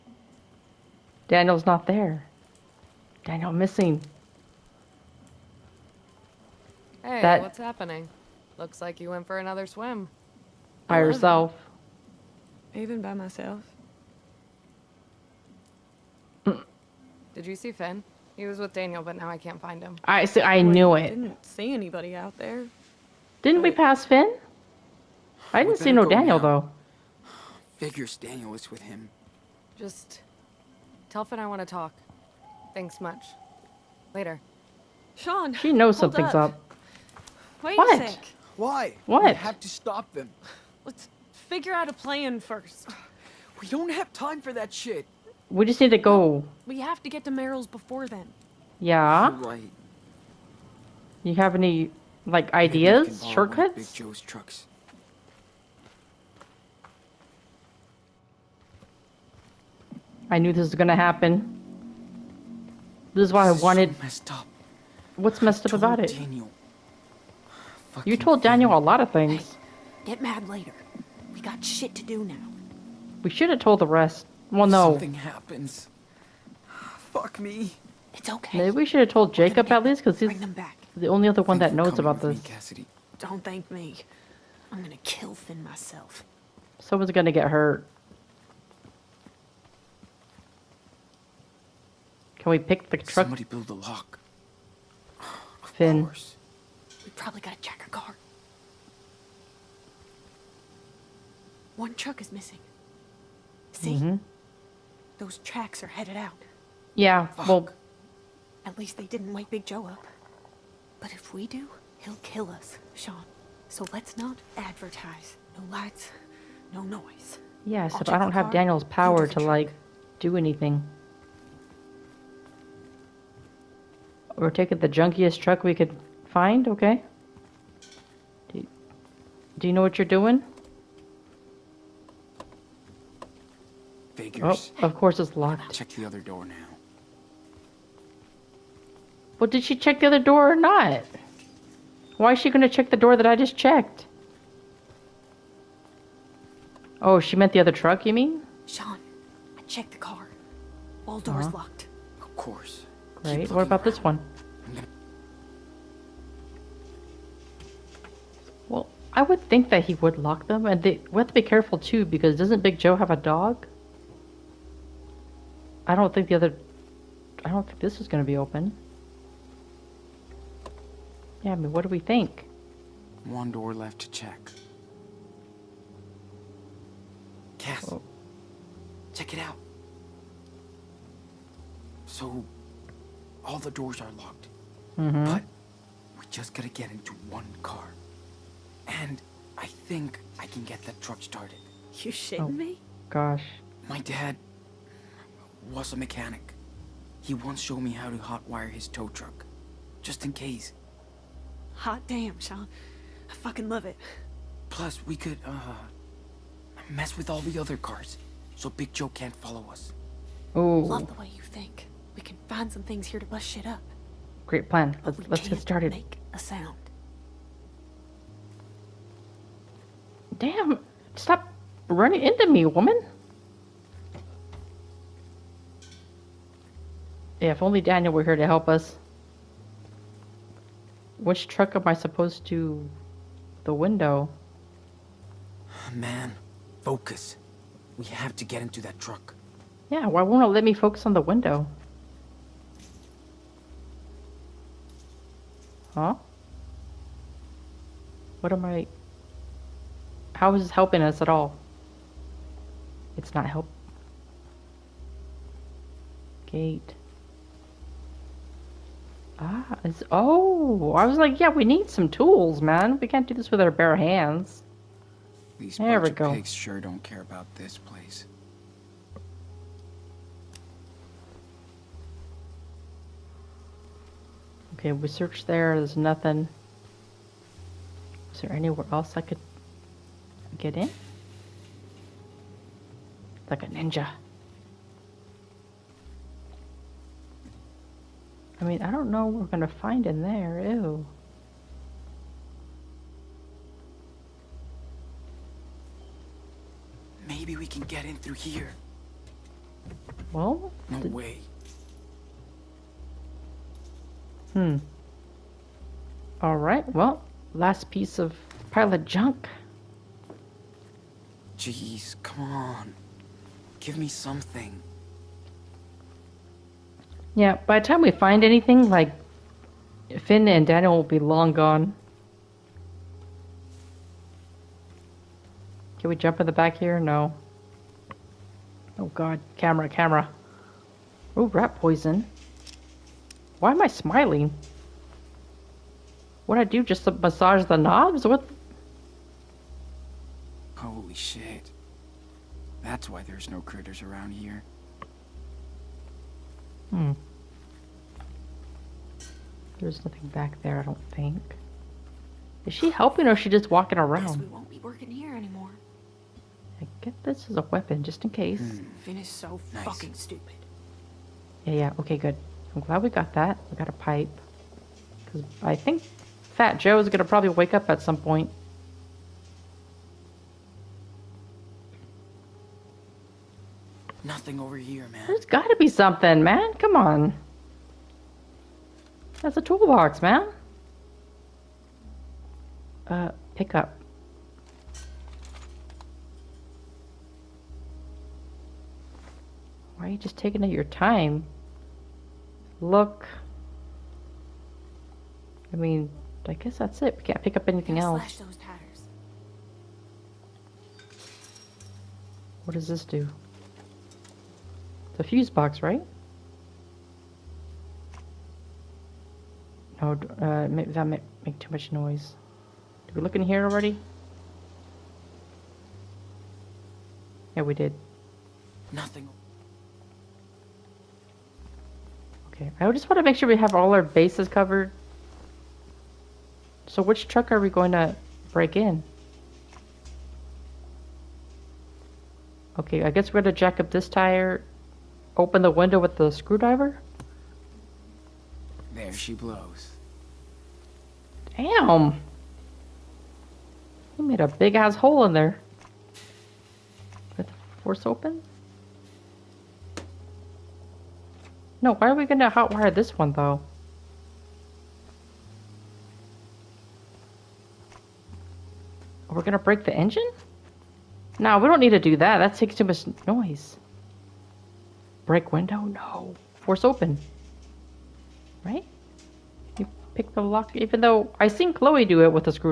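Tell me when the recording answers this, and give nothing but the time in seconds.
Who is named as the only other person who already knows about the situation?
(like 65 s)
79 s.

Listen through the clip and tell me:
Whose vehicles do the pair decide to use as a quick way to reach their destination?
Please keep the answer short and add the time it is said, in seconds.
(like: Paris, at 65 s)
Big Joe's trucks, at 53 s.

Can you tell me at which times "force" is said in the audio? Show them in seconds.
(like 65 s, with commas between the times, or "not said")
447 s, 466 s.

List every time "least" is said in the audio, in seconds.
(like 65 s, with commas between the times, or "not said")
79 s, 108 s.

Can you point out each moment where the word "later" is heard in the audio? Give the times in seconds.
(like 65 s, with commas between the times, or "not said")
34 s, 70 s.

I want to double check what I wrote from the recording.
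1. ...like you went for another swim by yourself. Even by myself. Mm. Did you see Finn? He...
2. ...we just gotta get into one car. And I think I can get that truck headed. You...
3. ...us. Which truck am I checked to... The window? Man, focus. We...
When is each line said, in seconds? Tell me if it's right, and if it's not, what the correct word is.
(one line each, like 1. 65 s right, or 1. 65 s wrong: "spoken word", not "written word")
1. 8 s right
2. 186 s wrong: "started", not "headed"
3. 228 s wrong: "supposed", not "checked".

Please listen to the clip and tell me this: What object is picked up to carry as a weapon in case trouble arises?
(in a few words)
A pipe.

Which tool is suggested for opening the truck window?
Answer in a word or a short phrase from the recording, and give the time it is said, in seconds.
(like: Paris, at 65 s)
Screwdriver, at 436 s.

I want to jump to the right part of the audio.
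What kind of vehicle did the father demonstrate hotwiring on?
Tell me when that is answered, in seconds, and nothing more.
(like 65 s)
198 s.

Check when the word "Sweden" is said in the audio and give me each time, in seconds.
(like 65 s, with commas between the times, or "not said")
not said.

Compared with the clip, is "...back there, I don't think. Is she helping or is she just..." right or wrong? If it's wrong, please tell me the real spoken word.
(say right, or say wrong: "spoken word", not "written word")
right.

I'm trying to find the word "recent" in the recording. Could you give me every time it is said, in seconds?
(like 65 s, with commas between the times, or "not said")
not said.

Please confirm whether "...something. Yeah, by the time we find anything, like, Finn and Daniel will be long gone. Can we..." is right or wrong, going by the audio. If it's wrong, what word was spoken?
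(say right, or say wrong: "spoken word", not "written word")
right.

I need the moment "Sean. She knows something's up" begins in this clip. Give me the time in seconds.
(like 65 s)
35 s.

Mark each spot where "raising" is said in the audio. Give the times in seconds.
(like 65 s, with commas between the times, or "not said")
not said.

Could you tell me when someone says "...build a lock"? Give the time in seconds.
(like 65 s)
93 s.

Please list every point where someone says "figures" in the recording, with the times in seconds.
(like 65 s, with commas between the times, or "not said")
27 s, 41 s.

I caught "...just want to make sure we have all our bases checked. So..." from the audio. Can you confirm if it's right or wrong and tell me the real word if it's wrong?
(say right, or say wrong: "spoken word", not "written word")
wrong: "covered", not "checked".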